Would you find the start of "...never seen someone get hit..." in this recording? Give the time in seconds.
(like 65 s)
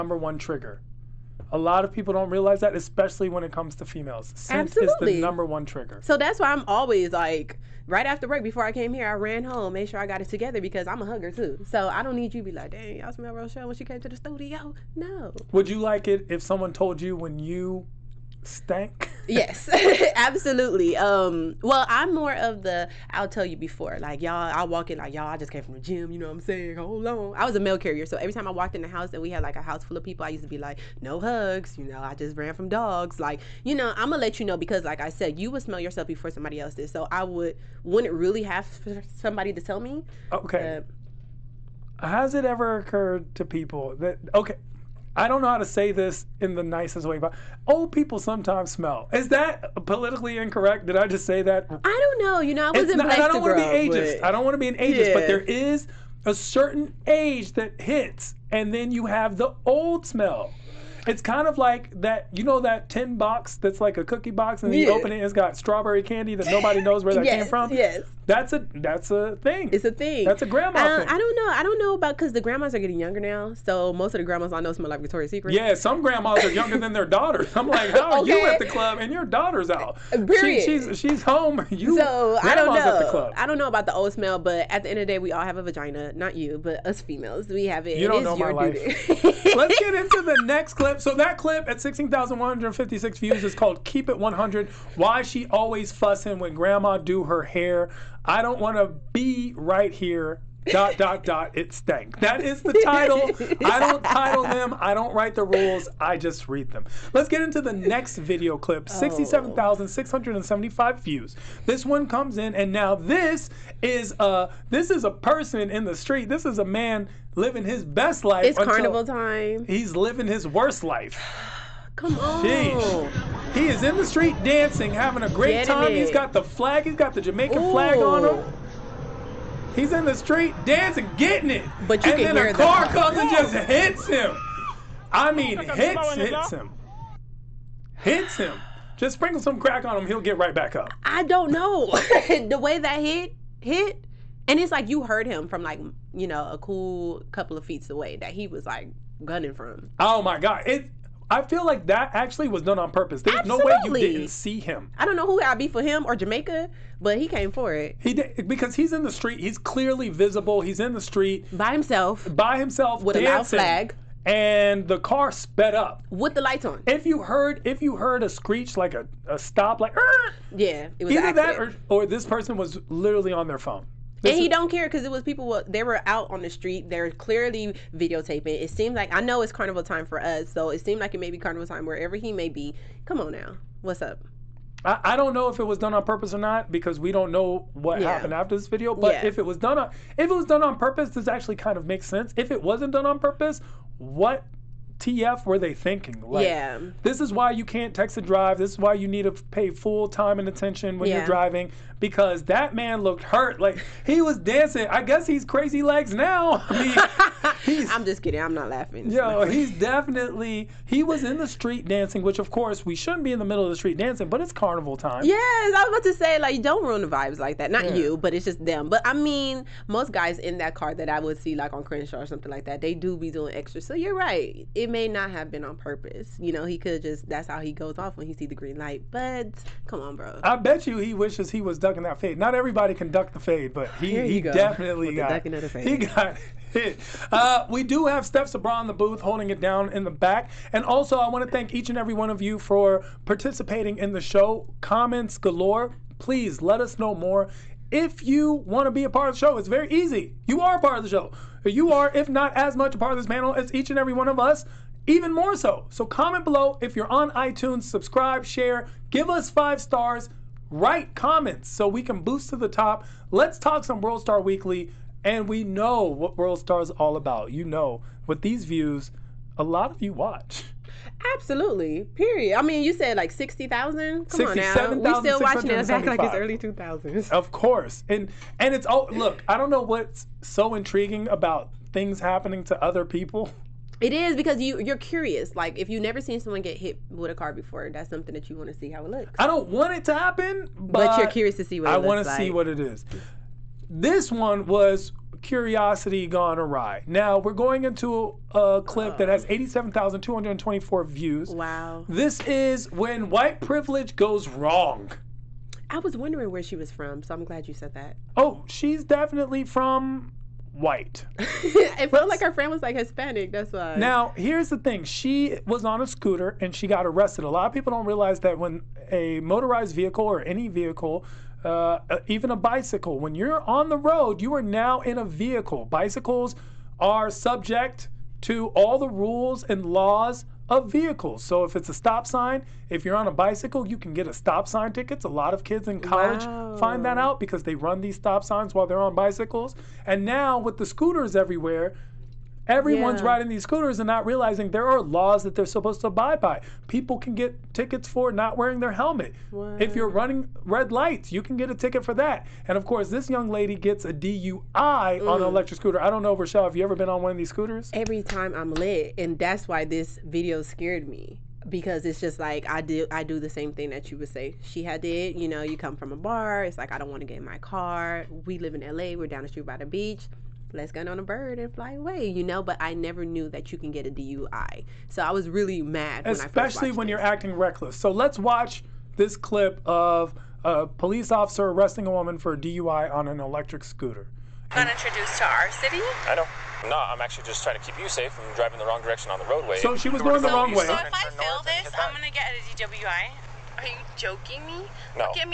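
286 s.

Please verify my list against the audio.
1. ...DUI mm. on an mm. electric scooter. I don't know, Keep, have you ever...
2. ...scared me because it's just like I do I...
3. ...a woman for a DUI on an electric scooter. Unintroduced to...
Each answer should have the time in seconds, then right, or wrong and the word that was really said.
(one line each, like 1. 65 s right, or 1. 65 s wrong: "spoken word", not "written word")
1. 354 s wrong: "Rochelle", not "Keep"
2. 360 s right
3. 382 s right.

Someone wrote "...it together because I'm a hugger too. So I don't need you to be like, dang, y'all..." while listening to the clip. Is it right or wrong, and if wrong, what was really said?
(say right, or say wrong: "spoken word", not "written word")
right.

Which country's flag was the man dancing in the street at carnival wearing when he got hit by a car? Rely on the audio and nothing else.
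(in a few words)
Jamaica.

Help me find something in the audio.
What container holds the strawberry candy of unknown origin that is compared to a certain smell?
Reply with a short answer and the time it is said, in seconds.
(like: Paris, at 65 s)
tin box, at 62 s.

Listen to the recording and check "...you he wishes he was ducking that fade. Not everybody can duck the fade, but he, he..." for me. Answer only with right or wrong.
right.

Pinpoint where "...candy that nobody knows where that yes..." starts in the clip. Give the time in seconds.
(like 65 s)
66 s.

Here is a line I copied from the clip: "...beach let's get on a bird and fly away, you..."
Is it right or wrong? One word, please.
right.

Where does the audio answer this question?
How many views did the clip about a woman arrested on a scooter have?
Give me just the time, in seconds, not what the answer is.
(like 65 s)
299 s.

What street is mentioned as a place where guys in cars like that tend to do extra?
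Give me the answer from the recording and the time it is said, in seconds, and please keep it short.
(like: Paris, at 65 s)
Crenshaw, at 221 s.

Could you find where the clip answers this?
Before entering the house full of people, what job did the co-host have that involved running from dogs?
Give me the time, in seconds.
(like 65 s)
27 s.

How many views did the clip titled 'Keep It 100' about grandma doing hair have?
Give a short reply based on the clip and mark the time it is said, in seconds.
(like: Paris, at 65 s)
16,156, at 91 s.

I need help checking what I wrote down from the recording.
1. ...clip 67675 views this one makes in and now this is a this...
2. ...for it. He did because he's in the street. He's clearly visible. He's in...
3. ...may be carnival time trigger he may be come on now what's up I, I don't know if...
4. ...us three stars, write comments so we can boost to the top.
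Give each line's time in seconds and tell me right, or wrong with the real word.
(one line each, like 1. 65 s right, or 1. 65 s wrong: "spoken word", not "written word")
1. 108 s wrong: "comes", not "makes"
2. 157 s right
3. 181 s wrong: "wherever", not "trigger"
4. 259 s wrong: "five", not "three".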